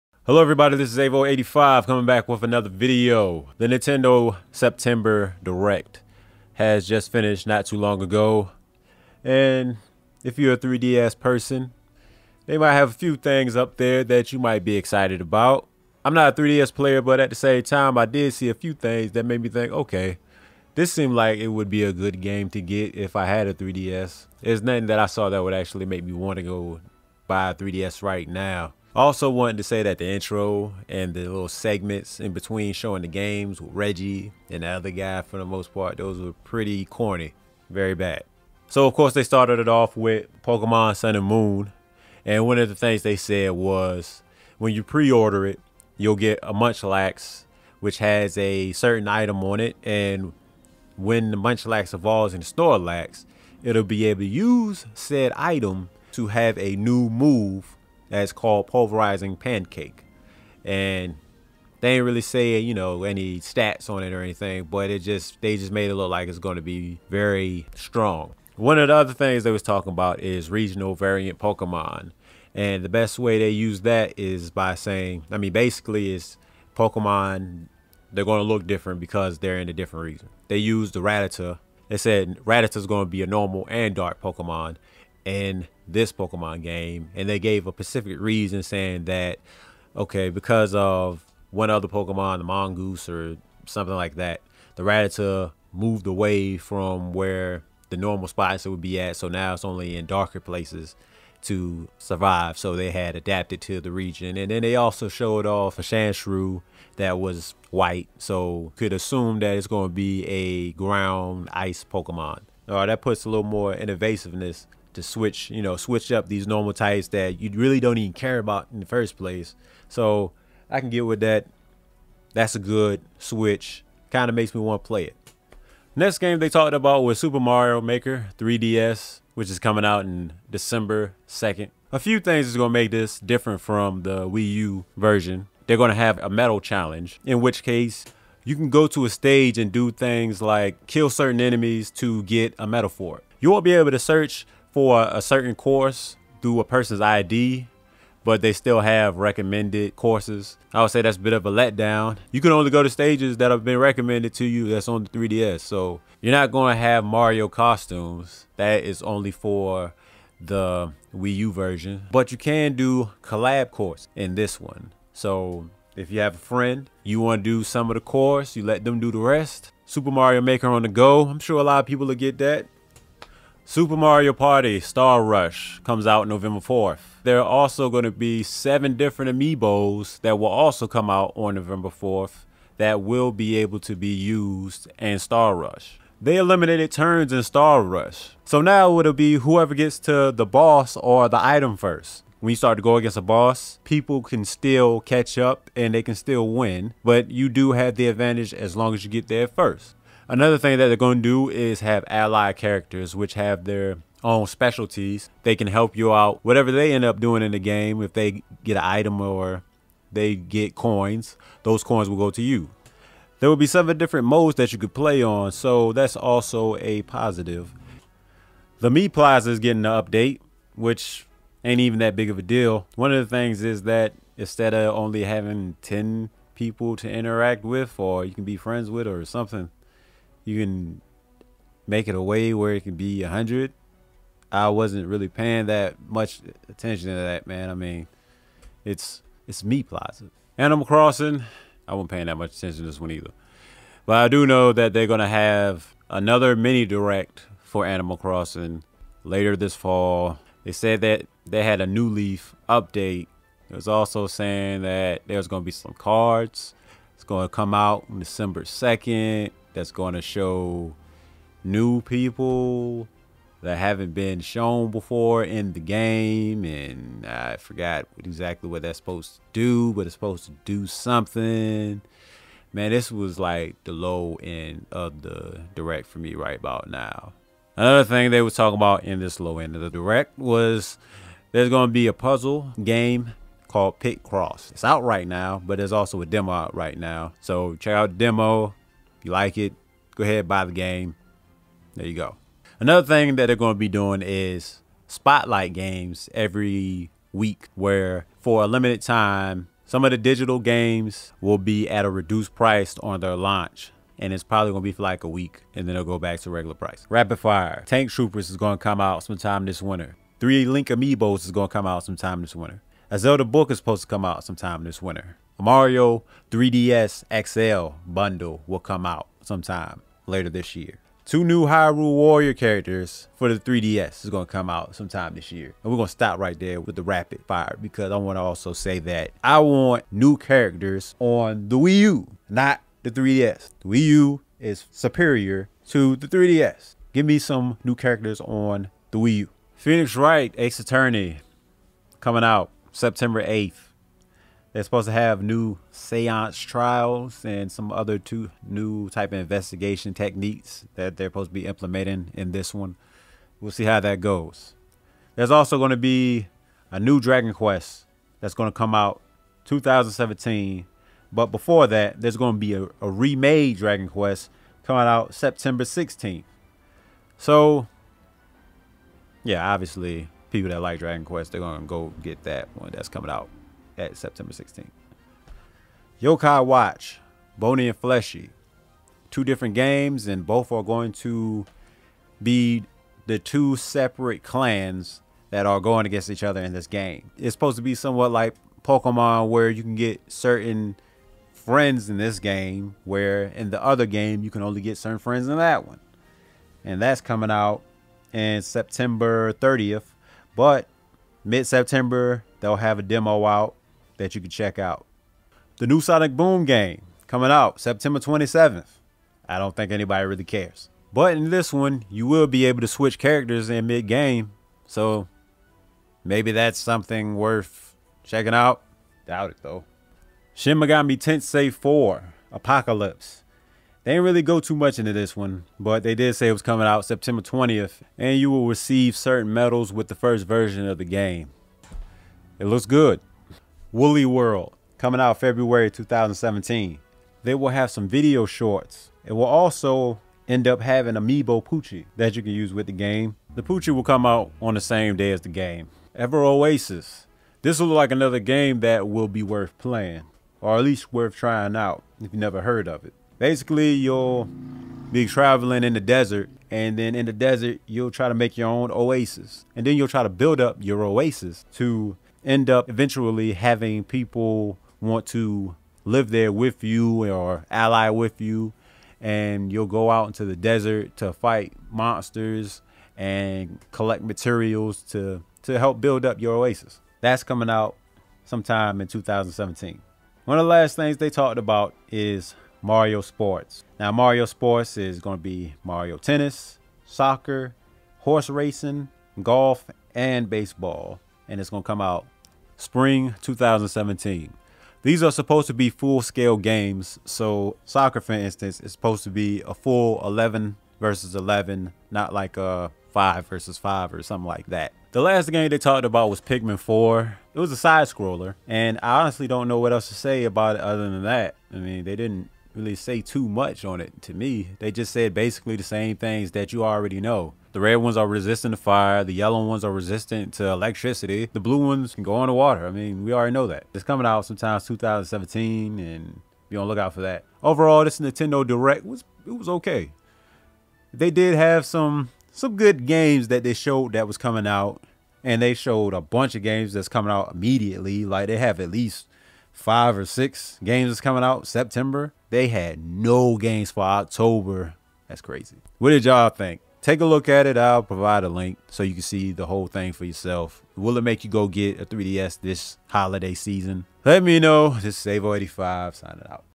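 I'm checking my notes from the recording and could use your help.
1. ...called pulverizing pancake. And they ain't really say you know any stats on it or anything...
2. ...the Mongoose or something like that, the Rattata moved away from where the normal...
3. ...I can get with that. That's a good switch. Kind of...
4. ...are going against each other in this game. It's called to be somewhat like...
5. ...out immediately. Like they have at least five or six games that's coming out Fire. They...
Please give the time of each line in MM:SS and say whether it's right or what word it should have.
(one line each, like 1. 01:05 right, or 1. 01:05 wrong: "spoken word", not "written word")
1. 00:58 right
2. 01:32 right
3. 02:00 right
4. 06:25 wrong: "supposed", not "called"
5. 08:57 wrong: "September", not "Fire".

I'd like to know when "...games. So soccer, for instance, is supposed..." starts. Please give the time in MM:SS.
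08:16.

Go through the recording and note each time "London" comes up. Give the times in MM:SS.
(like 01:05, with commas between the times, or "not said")
not said.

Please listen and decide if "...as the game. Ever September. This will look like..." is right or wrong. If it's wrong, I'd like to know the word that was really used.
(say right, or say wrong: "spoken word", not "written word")
wrong: "Oasis", not "September".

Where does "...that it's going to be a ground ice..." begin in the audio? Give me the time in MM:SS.
01:49.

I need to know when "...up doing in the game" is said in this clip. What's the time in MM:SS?
03:27.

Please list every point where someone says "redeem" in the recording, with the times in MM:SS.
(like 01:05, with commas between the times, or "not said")
not said.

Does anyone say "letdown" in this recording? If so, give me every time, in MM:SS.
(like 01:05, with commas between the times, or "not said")
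02:31.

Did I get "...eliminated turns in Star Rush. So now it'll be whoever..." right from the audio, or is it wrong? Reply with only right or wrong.
right.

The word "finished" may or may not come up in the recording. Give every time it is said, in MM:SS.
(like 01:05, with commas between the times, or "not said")
00:07.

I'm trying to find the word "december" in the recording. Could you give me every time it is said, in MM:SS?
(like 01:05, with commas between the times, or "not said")
02:10, 04:18.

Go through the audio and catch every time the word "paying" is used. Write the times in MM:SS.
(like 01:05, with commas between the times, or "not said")
03:55, 04:02.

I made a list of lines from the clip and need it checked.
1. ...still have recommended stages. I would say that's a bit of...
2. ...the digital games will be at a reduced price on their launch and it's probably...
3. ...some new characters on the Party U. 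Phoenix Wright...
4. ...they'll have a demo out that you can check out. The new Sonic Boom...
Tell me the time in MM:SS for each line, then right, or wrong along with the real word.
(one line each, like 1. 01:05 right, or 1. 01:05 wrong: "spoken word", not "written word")
1. 02:28 wrong: "courses", not "stages"
2. 05:00 right
3. 05:37 wrong: "Wii", not "Party"
4. 06:42 right.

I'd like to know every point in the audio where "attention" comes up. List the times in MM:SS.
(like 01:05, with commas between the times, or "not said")
03:56, 04:02.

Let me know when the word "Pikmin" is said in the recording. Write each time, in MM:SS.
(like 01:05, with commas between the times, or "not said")
08:26.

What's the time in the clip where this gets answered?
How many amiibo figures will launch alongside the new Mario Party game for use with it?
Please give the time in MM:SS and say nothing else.
02:58.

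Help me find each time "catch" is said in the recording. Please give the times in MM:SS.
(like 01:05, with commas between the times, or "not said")
03:15.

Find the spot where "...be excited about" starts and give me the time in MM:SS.
00:14.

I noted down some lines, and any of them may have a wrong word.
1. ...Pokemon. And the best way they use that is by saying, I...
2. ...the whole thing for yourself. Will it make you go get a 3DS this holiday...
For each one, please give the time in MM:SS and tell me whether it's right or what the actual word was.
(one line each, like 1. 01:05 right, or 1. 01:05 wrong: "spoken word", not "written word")
1. 01:11 right
2. 09:09 right.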